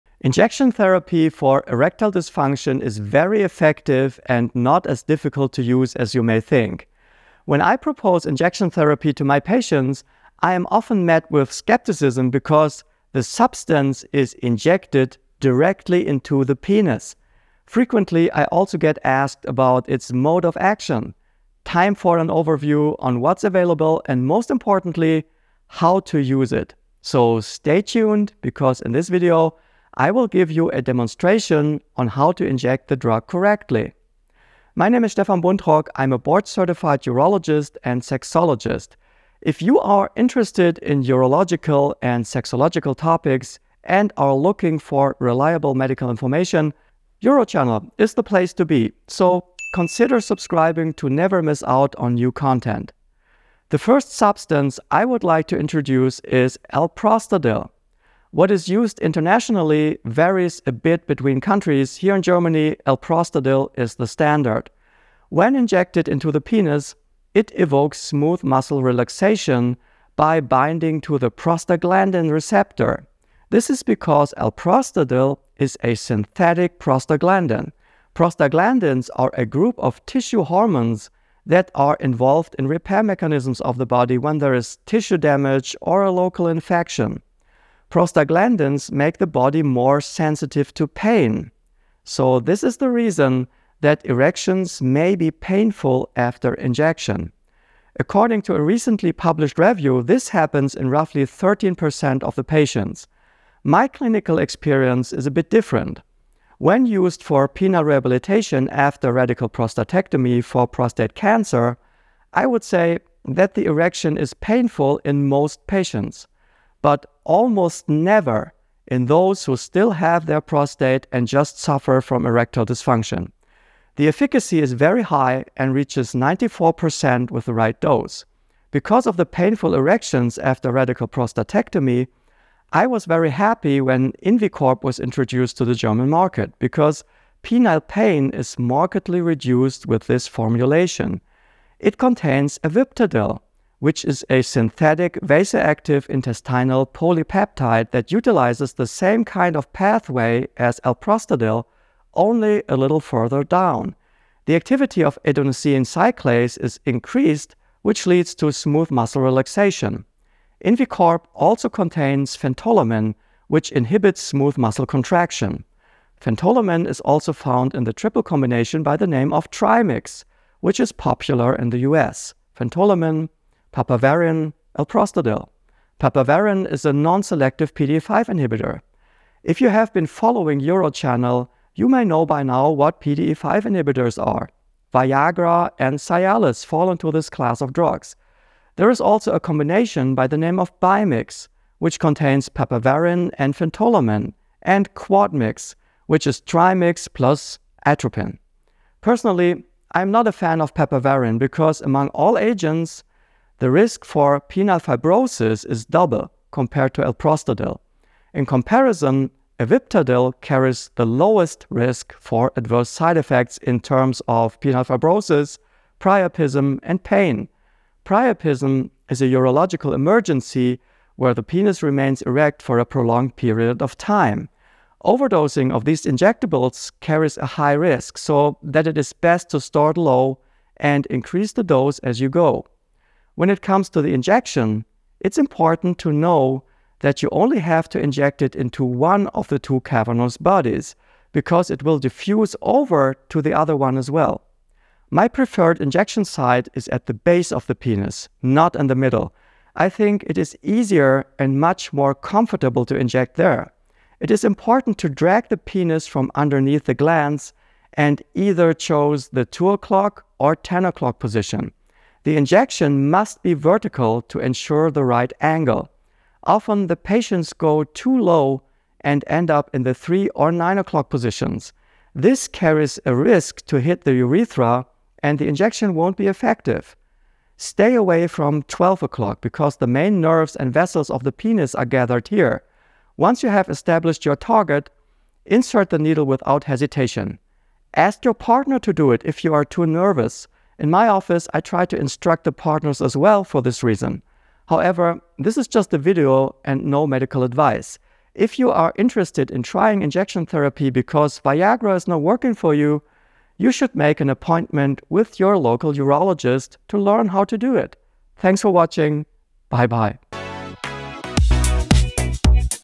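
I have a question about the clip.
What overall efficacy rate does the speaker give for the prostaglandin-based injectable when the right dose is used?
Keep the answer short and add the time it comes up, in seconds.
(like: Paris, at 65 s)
94%, at 126 s.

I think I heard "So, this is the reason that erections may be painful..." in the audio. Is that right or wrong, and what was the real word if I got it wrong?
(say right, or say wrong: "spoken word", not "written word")
right.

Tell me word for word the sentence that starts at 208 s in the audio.
In comparison, Aviptadil carries the lowest risk for adverse side effects in terms of penile fibrosis, priapism, and pain.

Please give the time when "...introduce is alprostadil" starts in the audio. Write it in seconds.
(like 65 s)
55 s.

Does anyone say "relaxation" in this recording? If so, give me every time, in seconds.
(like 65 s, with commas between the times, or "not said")
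68 s, 159 s.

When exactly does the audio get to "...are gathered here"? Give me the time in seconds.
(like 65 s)
281 s.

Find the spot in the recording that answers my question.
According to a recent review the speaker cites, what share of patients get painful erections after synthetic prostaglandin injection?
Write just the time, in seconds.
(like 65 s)
101 s.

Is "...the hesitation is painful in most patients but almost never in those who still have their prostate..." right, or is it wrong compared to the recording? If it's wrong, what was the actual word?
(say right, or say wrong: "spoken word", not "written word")
wrong: "erection", not "hesitation".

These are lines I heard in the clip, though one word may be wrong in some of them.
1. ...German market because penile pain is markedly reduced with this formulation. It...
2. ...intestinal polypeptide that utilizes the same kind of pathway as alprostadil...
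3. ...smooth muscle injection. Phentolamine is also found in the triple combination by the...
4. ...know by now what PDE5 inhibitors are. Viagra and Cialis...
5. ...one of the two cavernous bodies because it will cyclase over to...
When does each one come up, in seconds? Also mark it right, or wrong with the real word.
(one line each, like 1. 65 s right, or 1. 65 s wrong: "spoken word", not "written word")
1. 135 s right
2. 146 s right
3. 164 s wrong: "contraction", not "injection"
4. 182 s right
5. 238 s wrong: "diffuse", not "cyclase".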